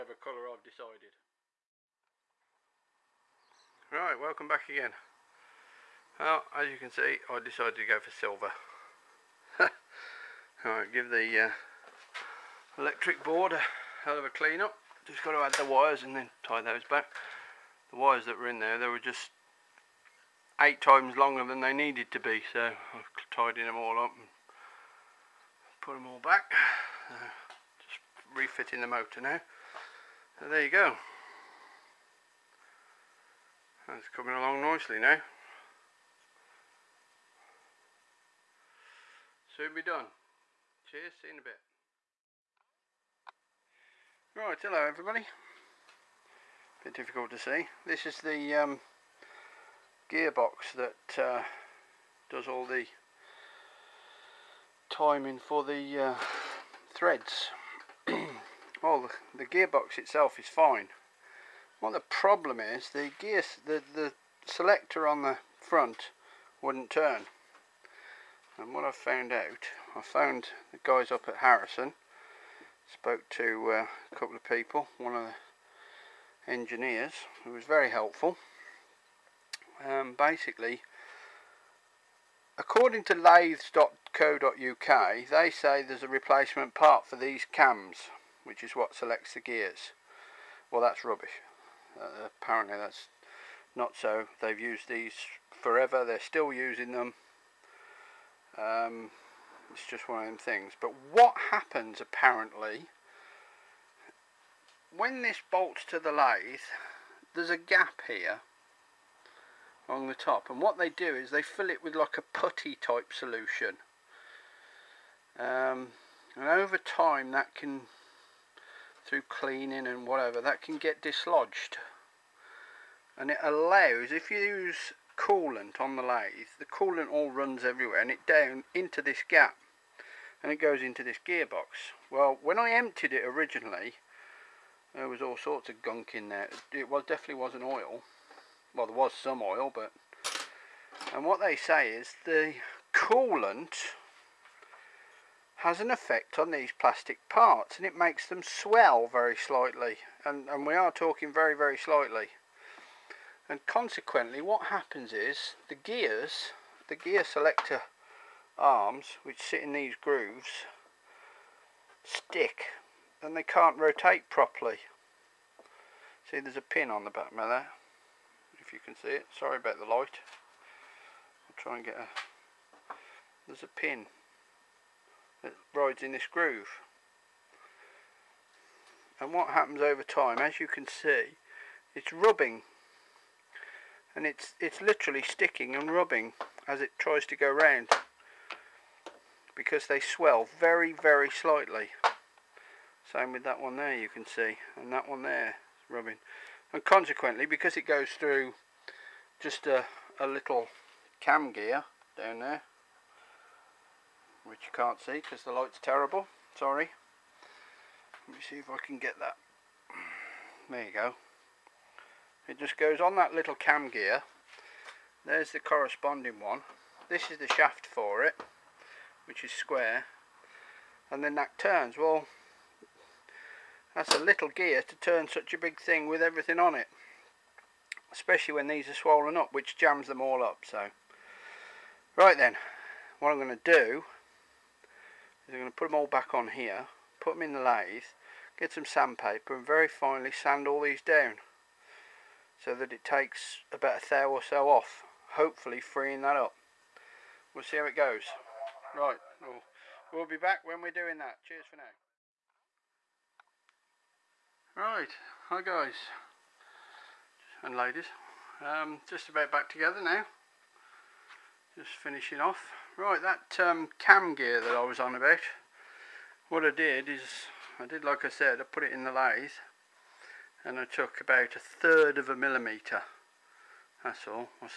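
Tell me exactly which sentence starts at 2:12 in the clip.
Well, when I emptied it originally, there was all sorts of gunk in there.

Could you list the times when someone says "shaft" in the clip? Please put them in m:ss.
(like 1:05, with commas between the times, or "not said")
3:37.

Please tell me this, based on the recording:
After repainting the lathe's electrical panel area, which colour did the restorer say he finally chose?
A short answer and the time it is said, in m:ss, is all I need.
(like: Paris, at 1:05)
silver, at 0:08.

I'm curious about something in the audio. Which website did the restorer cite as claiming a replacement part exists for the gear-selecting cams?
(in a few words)
lathes.co.uk.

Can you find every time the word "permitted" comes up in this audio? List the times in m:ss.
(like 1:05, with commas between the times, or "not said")
not said.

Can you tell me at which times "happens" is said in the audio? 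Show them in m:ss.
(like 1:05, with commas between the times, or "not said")
1:41, 2:34, 2:59.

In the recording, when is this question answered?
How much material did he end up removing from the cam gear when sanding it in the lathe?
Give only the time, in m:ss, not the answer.
4:31.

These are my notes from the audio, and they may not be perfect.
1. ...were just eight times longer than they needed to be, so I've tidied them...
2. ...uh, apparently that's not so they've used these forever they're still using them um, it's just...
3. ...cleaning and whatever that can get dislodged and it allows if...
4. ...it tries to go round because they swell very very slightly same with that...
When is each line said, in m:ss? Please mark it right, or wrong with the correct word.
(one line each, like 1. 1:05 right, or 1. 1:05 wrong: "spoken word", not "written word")
1. 0:18 right
2. 1:31 right
3. 1:59 right
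4. 3:06 right.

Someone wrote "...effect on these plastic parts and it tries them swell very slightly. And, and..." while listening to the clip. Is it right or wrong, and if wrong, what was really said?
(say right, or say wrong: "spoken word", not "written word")
wrong: "makes", not "tries".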